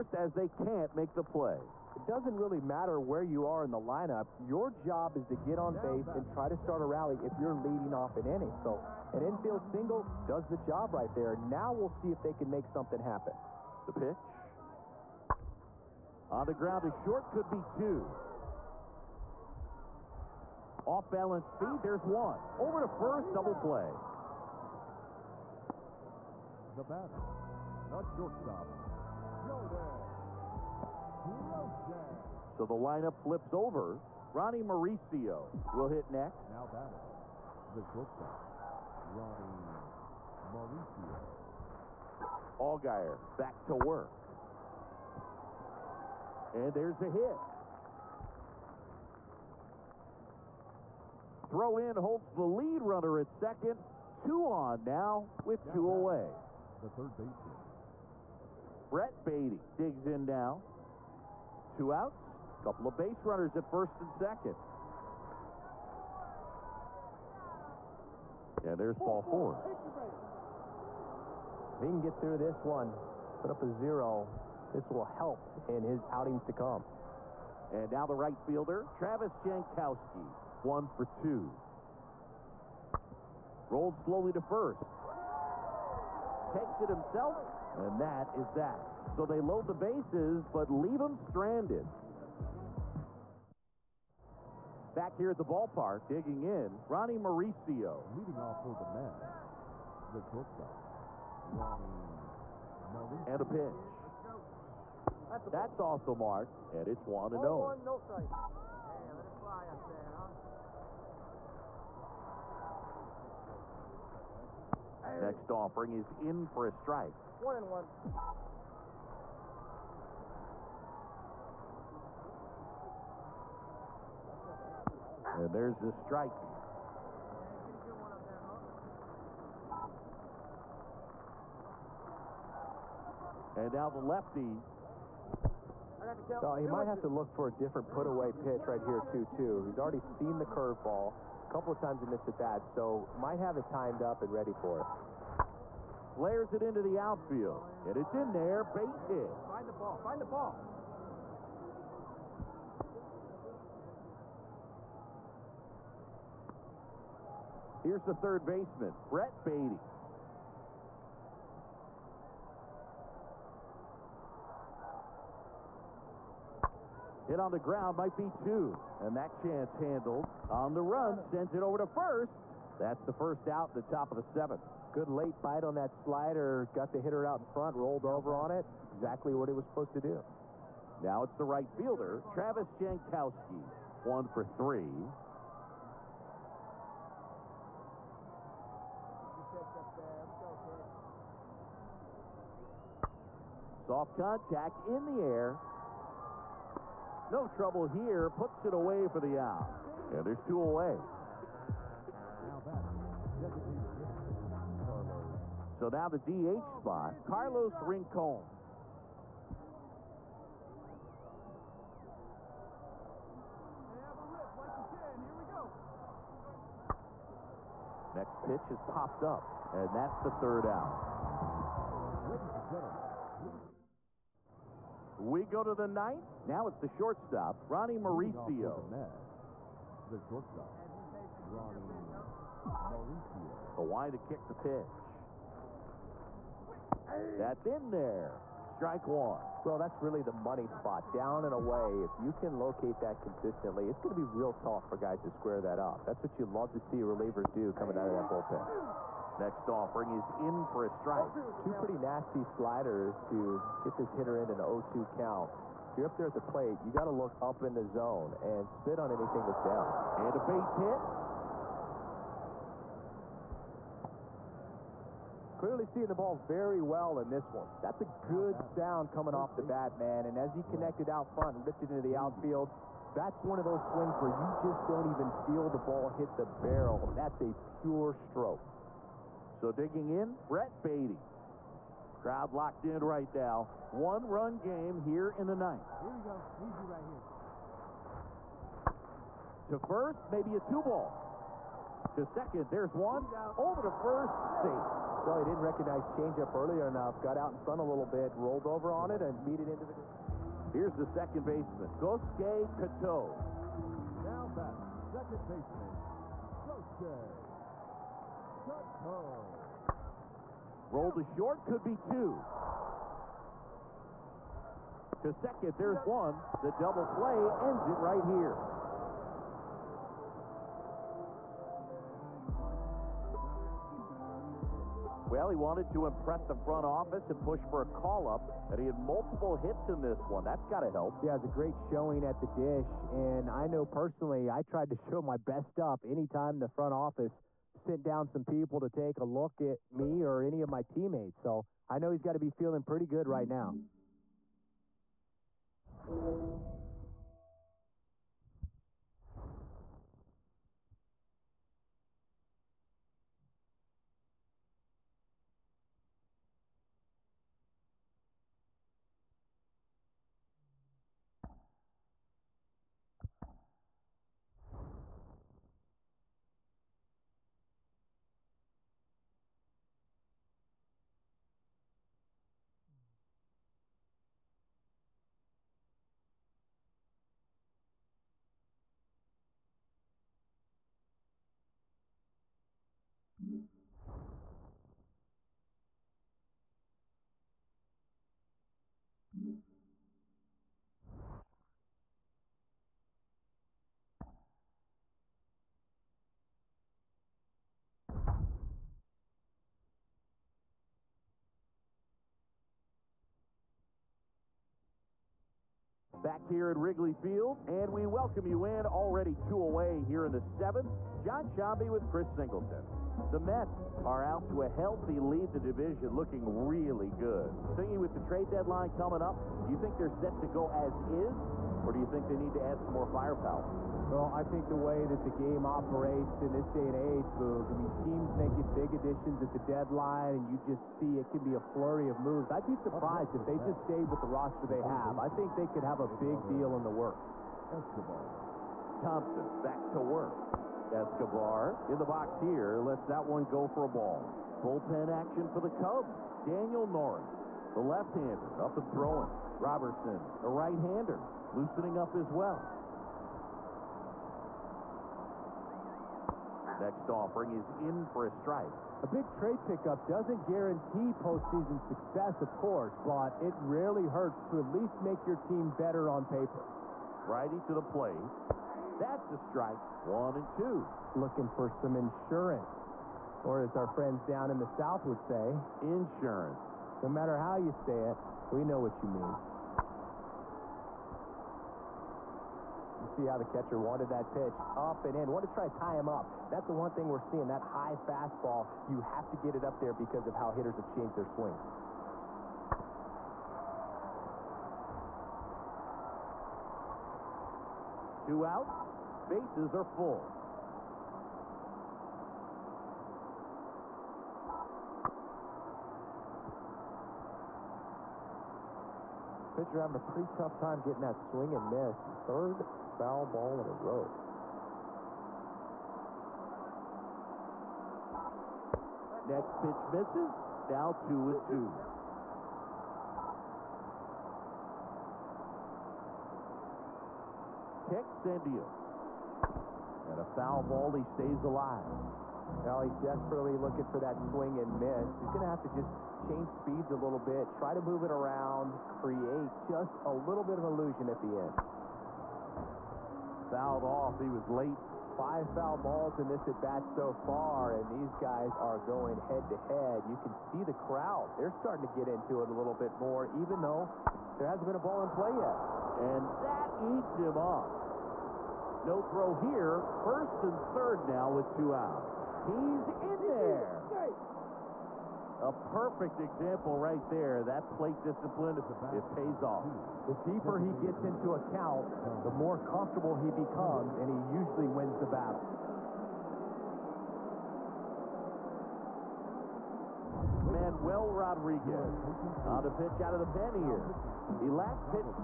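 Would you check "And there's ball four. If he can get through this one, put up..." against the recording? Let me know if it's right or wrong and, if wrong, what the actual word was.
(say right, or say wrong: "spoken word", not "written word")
right.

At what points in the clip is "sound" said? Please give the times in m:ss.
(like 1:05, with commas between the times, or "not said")
4:28.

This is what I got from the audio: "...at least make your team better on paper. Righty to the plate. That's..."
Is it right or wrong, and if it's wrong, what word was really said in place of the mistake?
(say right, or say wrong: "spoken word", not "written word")
right.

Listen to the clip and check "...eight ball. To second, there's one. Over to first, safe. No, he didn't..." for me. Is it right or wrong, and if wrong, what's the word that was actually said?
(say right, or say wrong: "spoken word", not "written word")
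wrong: "two", not "eight".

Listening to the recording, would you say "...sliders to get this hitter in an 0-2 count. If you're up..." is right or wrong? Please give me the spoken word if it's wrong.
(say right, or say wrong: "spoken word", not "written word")
right.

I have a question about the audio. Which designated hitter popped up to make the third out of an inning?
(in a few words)
Carlos Rincon.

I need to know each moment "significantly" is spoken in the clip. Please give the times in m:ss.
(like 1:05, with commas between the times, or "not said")
not said.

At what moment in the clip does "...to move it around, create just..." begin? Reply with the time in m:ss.
8:57.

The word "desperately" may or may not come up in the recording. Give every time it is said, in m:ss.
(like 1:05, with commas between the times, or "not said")
8:52.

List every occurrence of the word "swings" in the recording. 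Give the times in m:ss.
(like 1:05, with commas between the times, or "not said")
4:33, 8:11, 8:31, 8:54.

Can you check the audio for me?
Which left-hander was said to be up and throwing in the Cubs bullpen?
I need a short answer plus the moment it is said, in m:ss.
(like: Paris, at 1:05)
Daniel Norris, at 7:26.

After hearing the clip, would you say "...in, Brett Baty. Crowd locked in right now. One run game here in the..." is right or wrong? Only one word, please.
right.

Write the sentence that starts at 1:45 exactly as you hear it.
That's off the mark, and it's 1 0.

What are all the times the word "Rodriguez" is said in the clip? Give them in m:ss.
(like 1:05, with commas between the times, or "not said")
9:41.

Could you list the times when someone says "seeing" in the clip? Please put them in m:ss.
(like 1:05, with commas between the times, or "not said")
4:25, 8:07.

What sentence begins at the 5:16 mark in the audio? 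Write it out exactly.
The double play ends it right here.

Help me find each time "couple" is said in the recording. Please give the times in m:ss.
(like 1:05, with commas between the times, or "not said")
1:02, 2:21.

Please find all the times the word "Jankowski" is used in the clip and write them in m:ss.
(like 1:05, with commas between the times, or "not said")
1:19, 3:02.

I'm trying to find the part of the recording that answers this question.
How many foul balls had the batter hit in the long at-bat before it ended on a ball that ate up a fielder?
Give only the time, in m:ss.
9:05.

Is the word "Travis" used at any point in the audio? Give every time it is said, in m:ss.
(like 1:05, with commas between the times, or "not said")
1:18, 3:02.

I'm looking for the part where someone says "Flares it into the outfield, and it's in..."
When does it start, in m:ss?
2:26.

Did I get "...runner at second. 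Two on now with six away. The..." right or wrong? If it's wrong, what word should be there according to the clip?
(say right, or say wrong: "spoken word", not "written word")
wrong: "two", not "six".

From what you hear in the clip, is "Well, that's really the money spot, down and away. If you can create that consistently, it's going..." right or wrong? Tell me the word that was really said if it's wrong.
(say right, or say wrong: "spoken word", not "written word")
wrong: "locate", not "create".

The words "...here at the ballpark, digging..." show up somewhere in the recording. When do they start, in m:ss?
1:35.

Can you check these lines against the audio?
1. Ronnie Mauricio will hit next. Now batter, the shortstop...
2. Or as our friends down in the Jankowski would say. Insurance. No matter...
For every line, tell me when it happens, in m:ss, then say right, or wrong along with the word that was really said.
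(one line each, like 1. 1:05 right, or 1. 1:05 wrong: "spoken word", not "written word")
1. 0:34 right
2. 7:53 wrong: "South", not "Jankowski".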